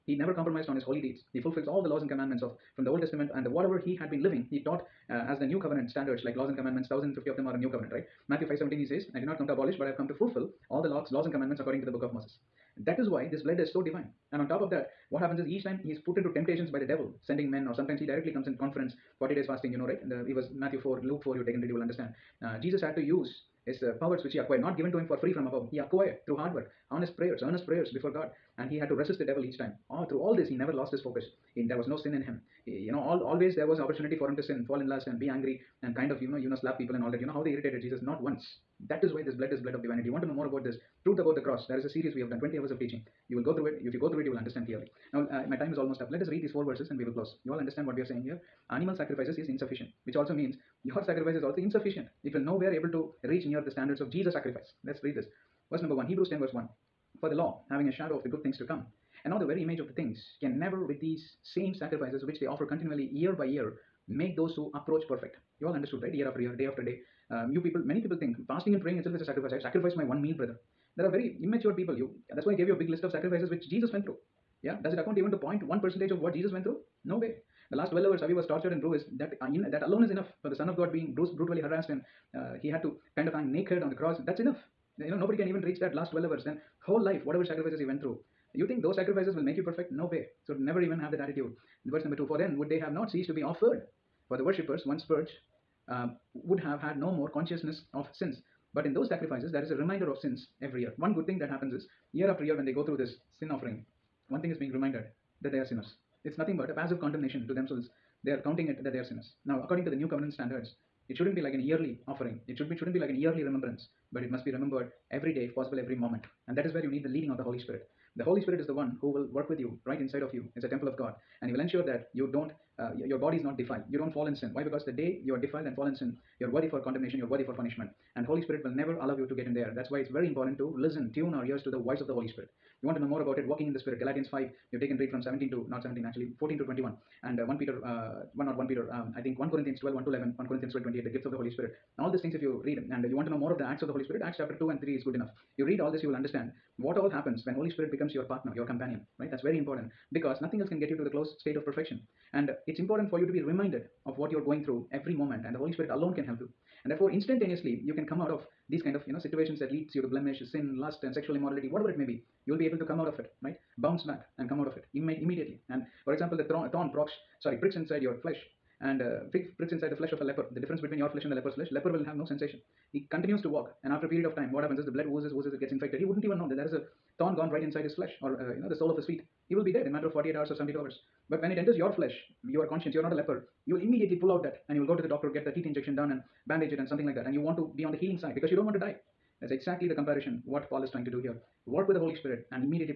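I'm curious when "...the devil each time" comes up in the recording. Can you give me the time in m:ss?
0:29.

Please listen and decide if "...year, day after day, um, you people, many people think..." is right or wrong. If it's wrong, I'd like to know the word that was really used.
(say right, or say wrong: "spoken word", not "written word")
right.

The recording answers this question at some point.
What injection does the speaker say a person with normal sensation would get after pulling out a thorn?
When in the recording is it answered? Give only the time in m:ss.
3:05.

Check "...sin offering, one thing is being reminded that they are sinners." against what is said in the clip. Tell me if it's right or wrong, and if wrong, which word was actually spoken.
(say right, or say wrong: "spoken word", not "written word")
right.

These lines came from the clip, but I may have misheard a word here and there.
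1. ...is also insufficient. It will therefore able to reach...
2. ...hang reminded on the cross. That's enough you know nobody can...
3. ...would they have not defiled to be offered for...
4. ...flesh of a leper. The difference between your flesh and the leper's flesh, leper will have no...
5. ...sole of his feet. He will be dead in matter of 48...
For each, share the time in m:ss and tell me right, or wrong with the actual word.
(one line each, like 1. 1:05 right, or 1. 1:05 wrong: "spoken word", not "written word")
1. 0:51 wrong: "nowhere", not "therefore"
2. 1:23 wrong: "naked", not "reminded"
3. 1:32 wrong: "ceased", not "defiled"
4. 2:49 right
5. 2:58 right.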